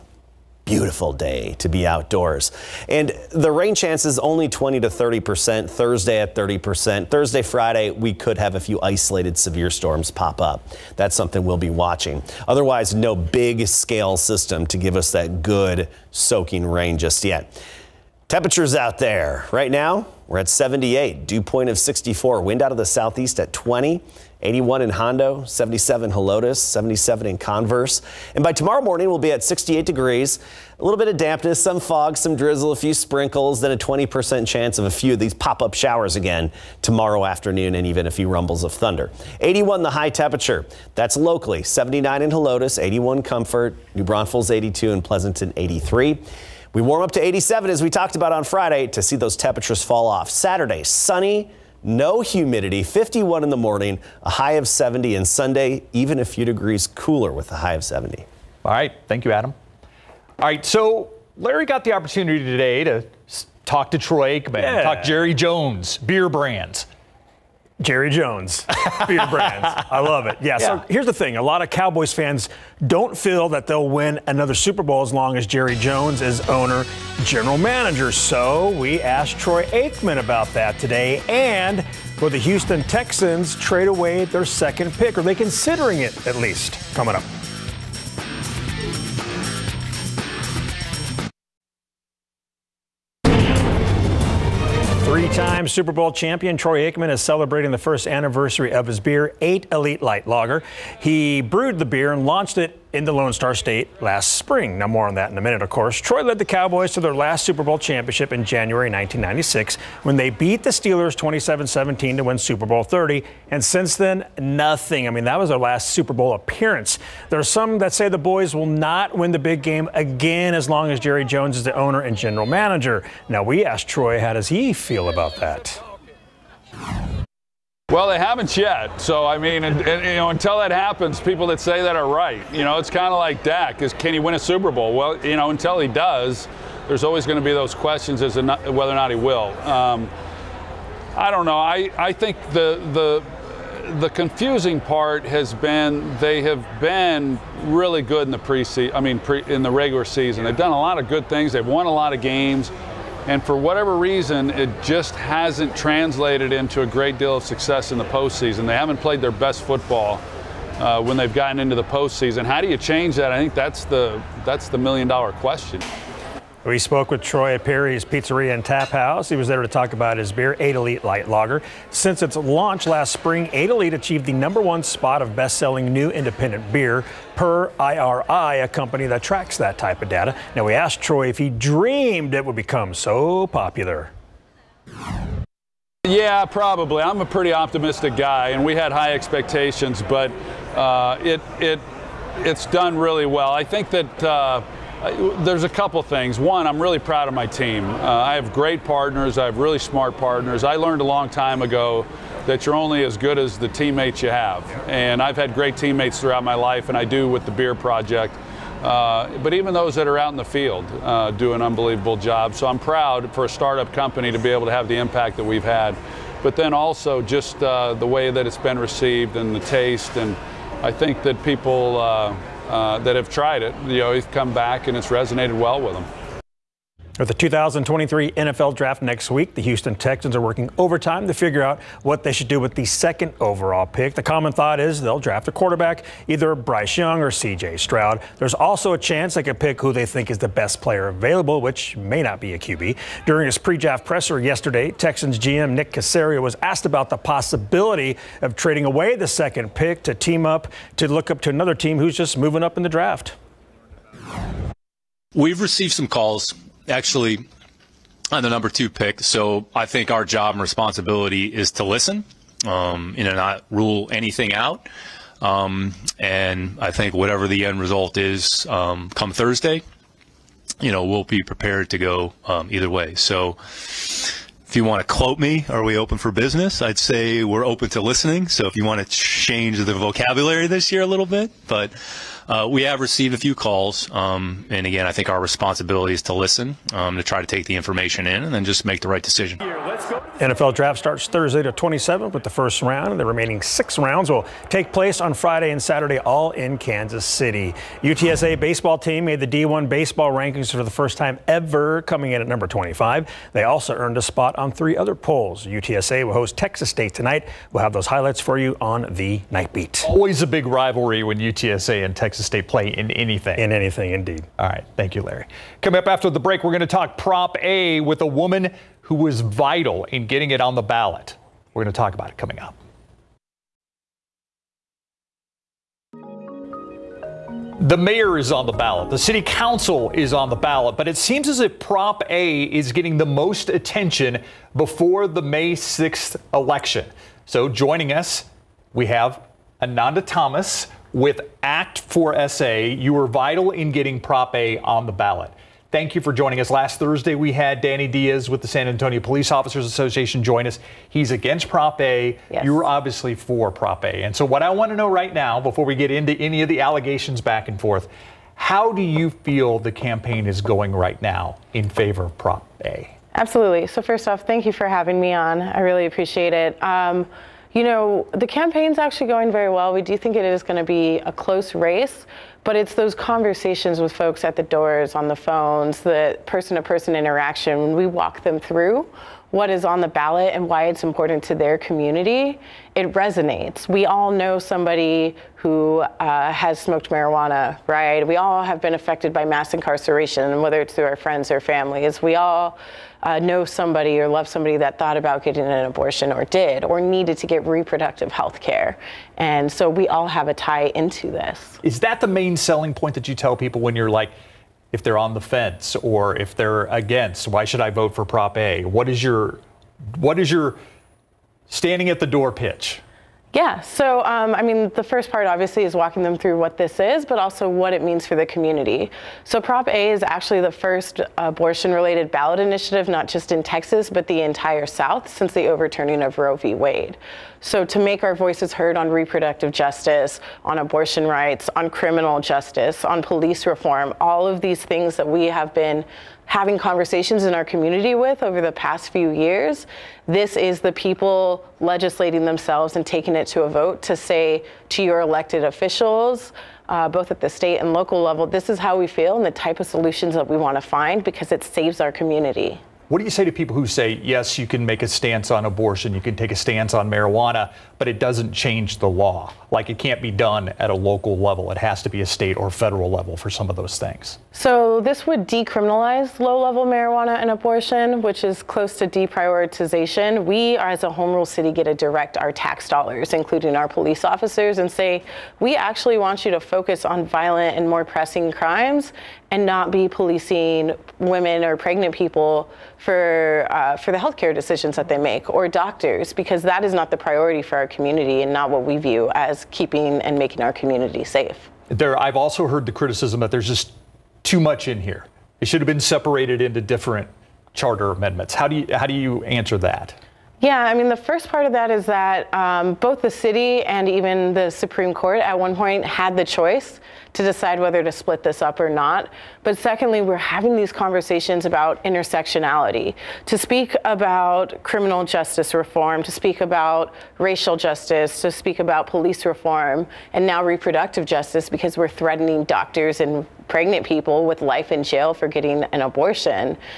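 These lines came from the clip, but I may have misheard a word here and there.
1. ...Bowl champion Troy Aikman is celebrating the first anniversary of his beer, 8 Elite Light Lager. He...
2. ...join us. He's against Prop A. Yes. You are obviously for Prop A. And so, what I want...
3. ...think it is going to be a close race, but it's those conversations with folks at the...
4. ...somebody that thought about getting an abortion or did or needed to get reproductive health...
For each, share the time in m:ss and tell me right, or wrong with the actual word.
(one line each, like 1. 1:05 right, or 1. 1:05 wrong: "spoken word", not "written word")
1. 1:35 right
2. 5:50 right
3. 6:10 right
4. 6:34 right.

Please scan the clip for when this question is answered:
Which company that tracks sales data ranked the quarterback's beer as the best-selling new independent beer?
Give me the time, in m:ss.
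2:57.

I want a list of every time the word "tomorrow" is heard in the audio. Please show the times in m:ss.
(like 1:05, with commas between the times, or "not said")
0:28, 0:36.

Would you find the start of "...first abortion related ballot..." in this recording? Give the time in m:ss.
7:00.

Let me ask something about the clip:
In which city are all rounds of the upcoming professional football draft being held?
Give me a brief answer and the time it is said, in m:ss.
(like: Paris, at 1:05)
Kansas City, at 4:56.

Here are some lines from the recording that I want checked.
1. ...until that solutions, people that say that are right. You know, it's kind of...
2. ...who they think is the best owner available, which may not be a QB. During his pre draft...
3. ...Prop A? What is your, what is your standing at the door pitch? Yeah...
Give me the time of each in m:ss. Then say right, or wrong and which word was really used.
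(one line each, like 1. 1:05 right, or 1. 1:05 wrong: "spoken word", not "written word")
1. 2:10 wrong: "happens", not "solutions"
2. 3:59 wrong: "player", not "owner"
3. 6:48 right.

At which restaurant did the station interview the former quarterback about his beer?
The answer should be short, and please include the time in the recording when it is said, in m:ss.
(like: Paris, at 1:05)
Perry's Pizzeria and Tap House, at 2:47.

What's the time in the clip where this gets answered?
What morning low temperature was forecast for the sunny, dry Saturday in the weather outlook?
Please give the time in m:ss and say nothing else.
0:52.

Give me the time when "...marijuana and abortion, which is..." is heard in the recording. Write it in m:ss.
7:46.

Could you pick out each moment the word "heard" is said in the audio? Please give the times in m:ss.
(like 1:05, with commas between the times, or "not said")
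7:08, 8:12.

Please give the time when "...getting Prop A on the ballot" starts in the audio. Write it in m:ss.
5:43.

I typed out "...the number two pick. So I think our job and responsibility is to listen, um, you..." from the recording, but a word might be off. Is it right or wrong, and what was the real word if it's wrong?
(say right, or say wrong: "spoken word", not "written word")
right.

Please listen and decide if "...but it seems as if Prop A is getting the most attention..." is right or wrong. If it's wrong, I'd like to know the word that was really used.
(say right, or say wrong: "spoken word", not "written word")
right.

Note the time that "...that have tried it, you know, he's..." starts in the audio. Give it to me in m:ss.
3:42.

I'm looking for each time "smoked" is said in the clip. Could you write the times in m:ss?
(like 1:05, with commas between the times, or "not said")
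6:26.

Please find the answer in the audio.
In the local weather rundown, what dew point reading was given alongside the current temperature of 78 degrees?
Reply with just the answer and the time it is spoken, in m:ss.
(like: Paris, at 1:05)
64, at 0:21.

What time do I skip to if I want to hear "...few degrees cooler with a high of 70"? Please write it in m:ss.
0:56.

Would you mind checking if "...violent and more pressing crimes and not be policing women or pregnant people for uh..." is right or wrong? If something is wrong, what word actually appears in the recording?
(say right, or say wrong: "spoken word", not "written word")
right.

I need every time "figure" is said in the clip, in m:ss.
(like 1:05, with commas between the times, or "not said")
3:51.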